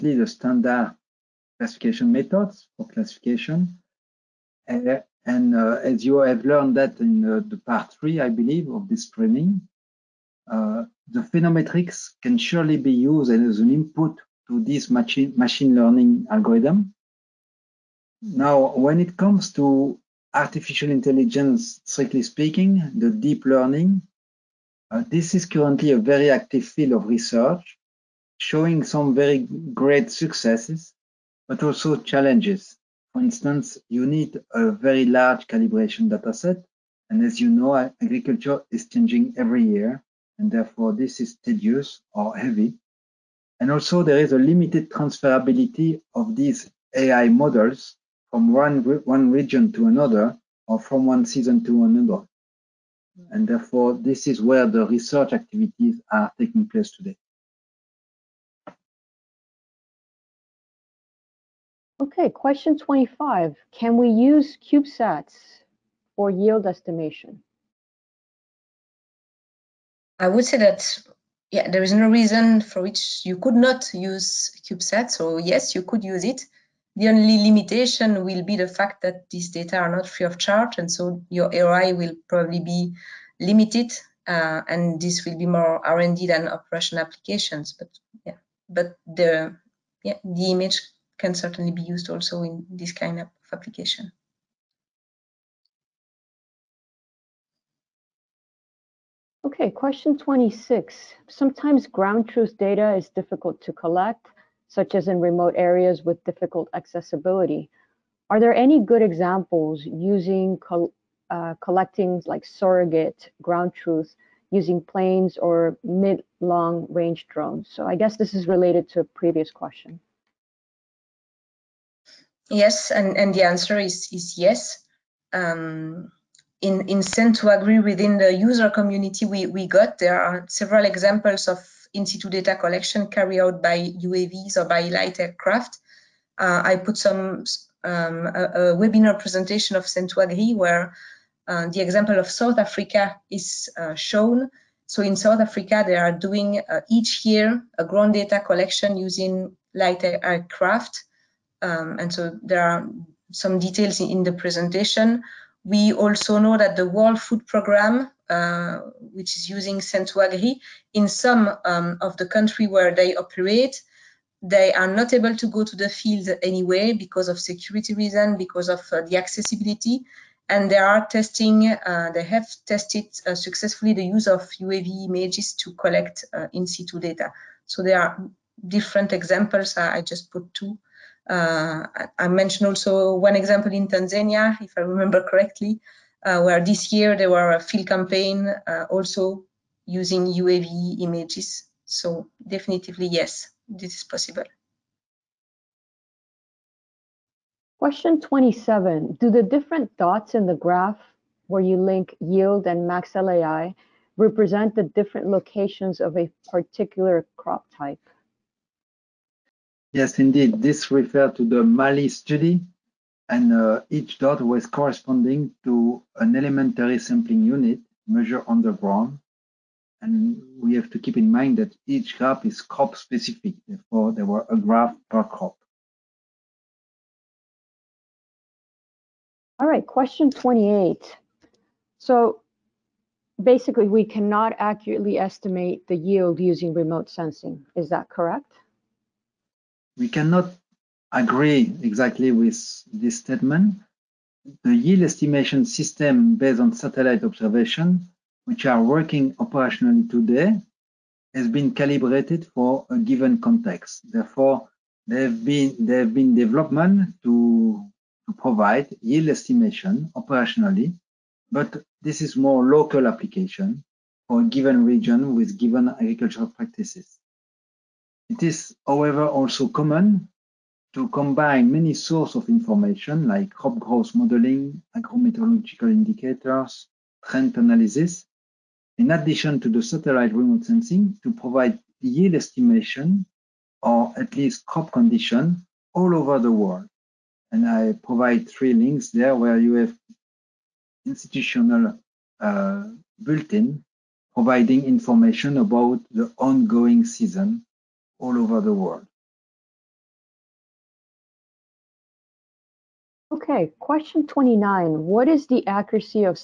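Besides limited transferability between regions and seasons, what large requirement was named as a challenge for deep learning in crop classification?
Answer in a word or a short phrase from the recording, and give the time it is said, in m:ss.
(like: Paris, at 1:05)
Large calibration dataset, at 0:34.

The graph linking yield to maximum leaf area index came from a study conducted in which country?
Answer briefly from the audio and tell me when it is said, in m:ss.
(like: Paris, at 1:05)
Mali, at 3:31.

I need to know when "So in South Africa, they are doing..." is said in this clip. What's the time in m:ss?
2:24.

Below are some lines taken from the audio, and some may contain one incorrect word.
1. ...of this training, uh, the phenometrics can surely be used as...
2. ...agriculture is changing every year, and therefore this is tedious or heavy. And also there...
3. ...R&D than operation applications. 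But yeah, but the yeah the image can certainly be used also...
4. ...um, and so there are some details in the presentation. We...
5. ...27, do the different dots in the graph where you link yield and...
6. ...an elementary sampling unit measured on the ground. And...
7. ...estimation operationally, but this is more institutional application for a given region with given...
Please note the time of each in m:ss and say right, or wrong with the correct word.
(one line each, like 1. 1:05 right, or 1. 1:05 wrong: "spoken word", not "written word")
1. 0:08 right
2. 0:37 right
3. 1:25 right
4. 2:31 right
5. 3:18 right
6. 3:36 right
7. 4:19 wrong: "local", not "institutional".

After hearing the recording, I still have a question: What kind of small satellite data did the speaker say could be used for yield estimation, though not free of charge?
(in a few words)
CubeSats.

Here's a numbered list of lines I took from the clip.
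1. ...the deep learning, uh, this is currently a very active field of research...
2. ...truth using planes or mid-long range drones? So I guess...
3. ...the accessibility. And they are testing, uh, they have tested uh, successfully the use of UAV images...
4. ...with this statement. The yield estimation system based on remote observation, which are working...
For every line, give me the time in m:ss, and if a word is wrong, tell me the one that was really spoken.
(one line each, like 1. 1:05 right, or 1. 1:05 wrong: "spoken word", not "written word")
1. 0:22 right
2. 1:53 right
3. 2:49 right
4. 4:02 wrong: "satellite", not "remote".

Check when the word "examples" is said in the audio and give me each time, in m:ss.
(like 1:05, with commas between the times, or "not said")
1:49, 2:10, 2:21, 2:59, 3:03.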